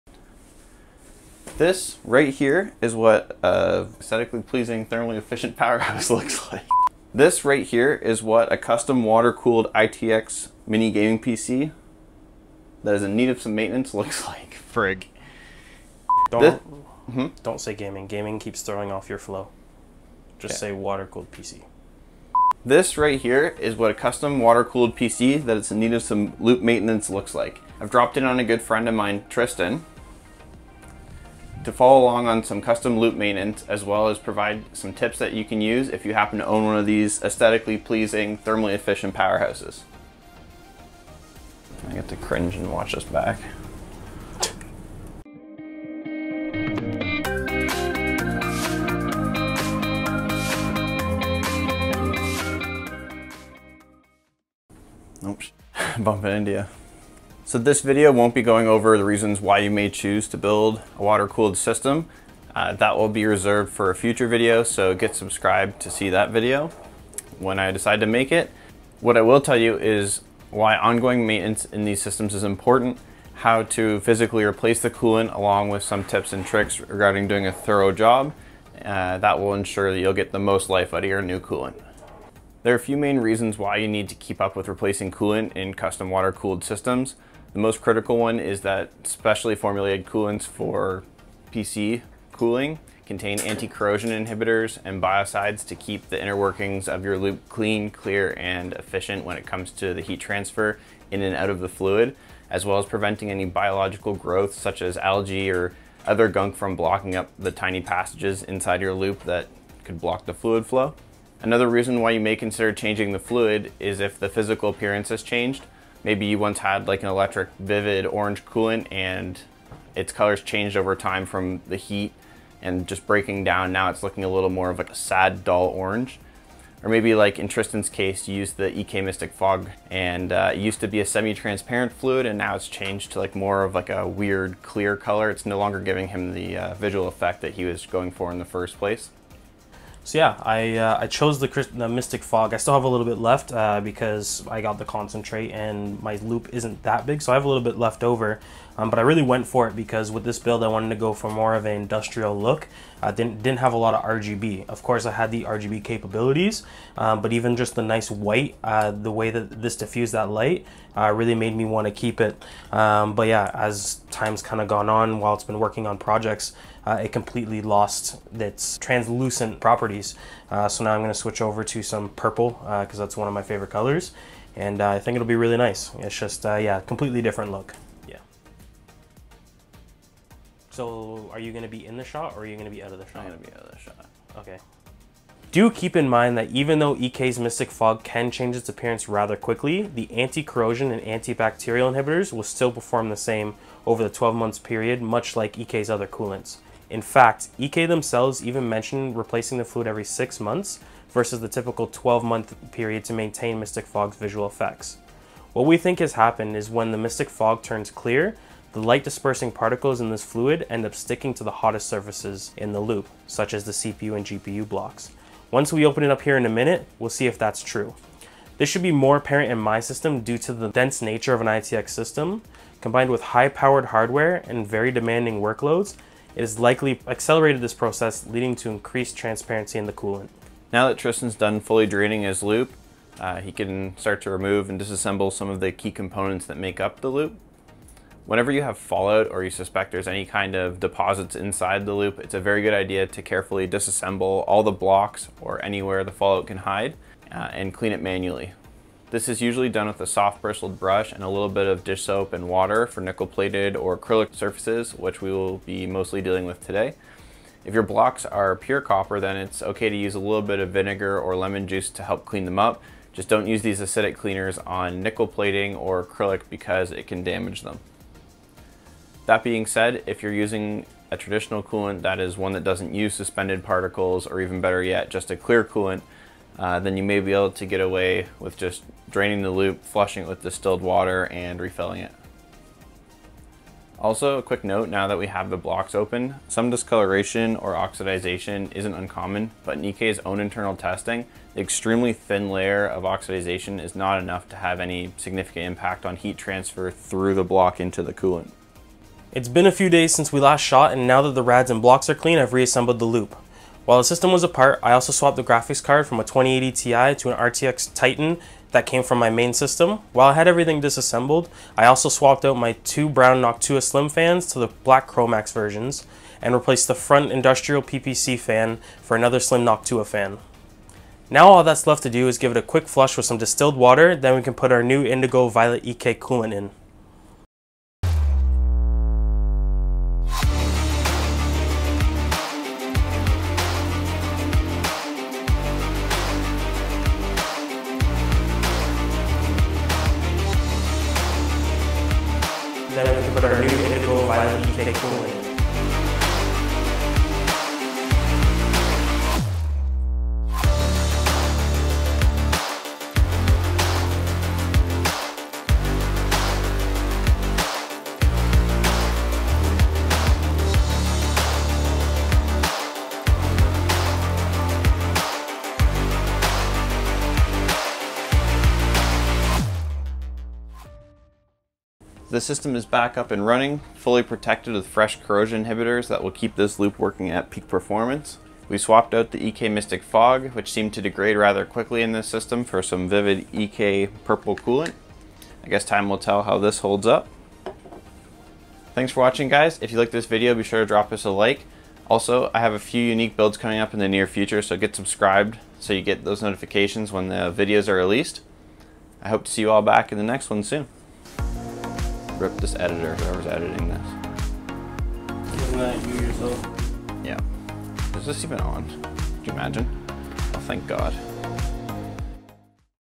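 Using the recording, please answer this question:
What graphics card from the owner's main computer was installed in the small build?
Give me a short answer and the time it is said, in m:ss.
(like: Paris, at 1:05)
RTX Titan, at 5:07.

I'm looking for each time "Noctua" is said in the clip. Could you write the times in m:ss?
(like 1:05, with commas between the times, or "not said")
5:13, 5:19.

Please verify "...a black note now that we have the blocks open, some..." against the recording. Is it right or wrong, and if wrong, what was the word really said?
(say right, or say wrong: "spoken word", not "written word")
wrong: "quick", not "black".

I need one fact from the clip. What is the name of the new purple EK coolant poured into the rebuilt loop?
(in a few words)
Indigo Violet.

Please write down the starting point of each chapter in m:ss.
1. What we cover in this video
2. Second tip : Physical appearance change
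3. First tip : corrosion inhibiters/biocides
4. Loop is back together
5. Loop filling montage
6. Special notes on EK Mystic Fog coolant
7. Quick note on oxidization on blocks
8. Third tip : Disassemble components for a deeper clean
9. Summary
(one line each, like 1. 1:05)
1. 1:09
2. 1:51
3. 1:22
4. 4:59
5. 5:27
6. 3:05
7. 4:43
8. 3:50
9. 6:12.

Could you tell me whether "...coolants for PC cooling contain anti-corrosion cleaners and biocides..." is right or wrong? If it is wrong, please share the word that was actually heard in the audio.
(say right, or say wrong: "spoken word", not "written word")
wrong: "inhibitors", not "cleaners".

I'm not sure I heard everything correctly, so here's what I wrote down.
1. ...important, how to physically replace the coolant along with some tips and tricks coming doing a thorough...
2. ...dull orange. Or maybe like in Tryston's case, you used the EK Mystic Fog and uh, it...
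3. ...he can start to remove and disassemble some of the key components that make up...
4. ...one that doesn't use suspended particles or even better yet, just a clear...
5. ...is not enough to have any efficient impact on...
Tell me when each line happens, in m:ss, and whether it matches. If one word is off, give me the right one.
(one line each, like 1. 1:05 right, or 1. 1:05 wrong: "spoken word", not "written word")
1. 1:12 wrong: "regarding", not "coming"
2. 2:05 right
3. 3:53 right
4. 4:32 right
5. 4:53 wrong: "significant", not "efficient".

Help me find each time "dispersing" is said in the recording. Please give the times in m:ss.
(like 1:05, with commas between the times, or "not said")
3:29.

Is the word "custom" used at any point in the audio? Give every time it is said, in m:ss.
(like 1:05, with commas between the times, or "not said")
0:08, 0:24, 0:32, 1:25.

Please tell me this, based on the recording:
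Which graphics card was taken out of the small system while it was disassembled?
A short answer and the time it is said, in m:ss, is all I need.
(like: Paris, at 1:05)
2080 Ti, at 5:06.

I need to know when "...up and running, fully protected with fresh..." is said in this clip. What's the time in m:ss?
6:13.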